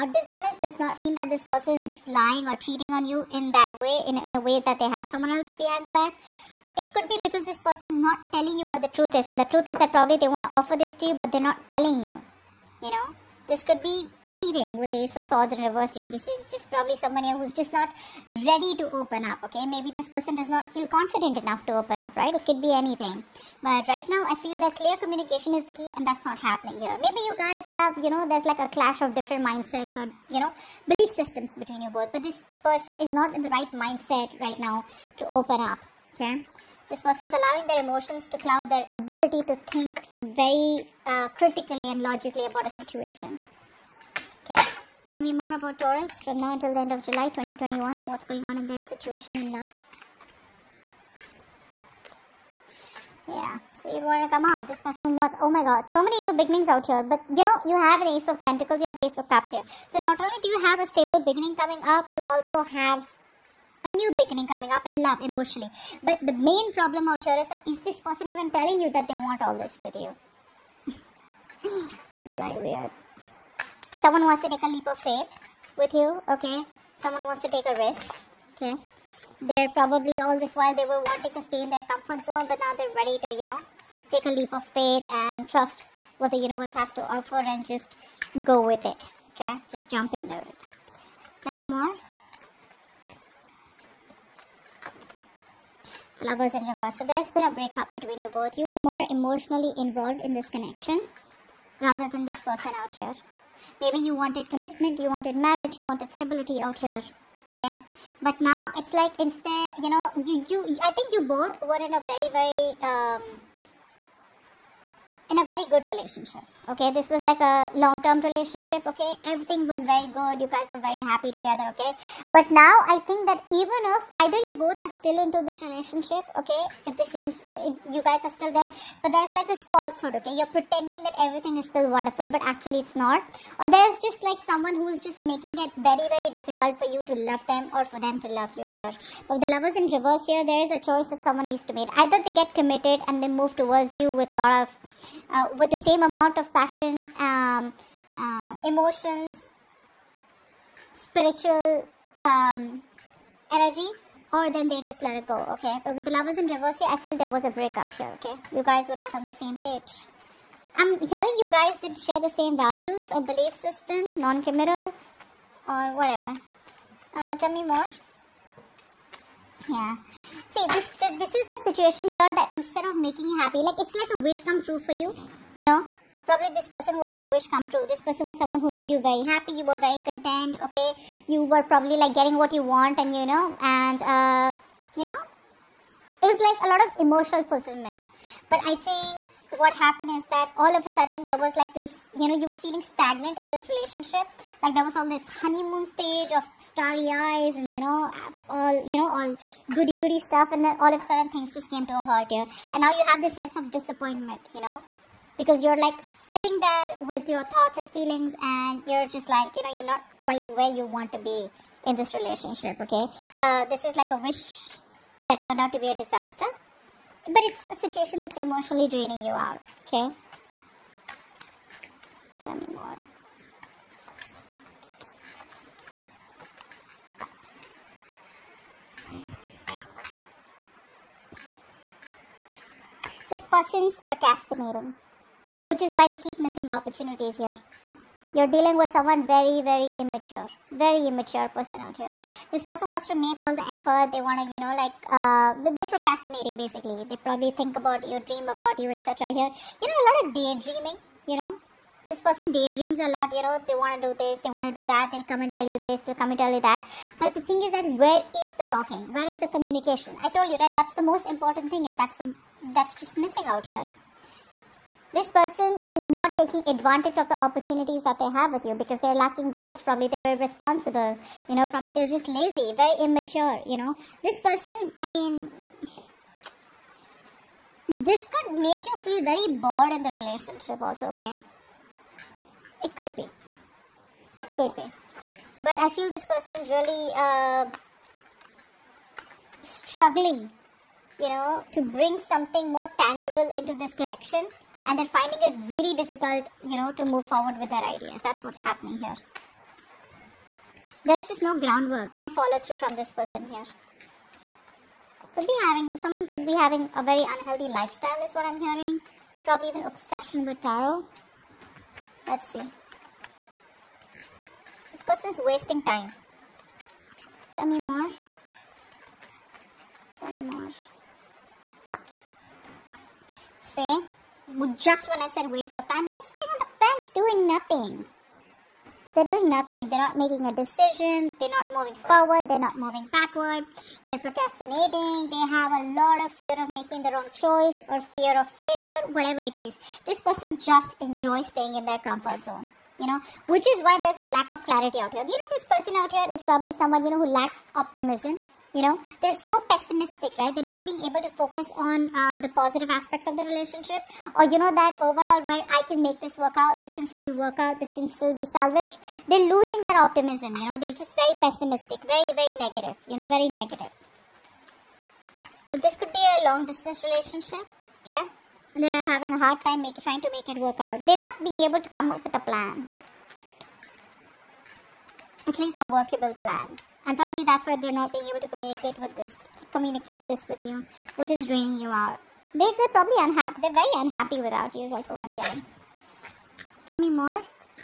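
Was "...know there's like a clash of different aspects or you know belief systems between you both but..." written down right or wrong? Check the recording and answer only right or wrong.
wrong.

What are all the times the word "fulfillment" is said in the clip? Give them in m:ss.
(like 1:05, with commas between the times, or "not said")
3:07.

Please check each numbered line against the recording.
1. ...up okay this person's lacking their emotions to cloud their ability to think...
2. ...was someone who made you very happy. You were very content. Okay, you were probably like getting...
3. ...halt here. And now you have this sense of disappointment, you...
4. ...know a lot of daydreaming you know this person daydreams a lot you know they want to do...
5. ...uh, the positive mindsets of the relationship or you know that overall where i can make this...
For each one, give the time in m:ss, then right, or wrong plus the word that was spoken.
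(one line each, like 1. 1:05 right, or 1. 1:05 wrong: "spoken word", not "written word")
1. 0:35 wrong: "allowing", not "lacking"
2. 2:58 right
3. 3:22 right
4. 4:09 right
5. 5:52 wrong: "aspects", not "mindsets".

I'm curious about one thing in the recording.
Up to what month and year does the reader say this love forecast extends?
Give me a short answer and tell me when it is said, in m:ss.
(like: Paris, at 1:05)
July 2021, at 0:47.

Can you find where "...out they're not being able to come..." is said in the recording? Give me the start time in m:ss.
6:10.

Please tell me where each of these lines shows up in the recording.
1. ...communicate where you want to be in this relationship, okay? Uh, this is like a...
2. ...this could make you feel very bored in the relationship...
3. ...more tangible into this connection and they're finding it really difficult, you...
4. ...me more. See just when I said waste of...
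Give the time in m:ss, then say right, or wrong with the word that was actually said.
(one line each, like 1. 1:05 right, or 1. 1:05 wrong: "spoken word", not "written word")
1. 3:30 wrong: "quite", not "communicate"
2. 4:37 right
3. 4:52 right
4. 5:20 right.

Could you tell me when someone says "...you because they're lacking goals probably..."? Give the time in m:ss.
4:28.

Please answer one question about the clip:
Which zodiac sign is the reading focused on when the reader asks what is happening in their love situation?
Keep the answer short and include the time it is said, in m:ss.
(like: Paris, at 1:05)
Taurus, at 0:45.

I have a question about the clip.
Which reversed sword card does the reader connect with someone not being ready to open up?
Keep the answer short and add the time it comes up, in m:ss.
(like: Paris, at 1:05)
Ace of Swords, at 0:14.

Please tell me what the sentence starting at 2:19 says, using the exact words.
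But the lovers in reverse here, there is a choice that someone needs to make.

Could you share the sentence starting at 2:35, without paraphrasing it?
But with the lovers in reverse here, I feel there was a breakup here, okay?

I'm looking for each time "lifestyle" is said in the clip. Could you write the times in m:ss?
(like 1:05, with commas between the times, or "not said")
5:07.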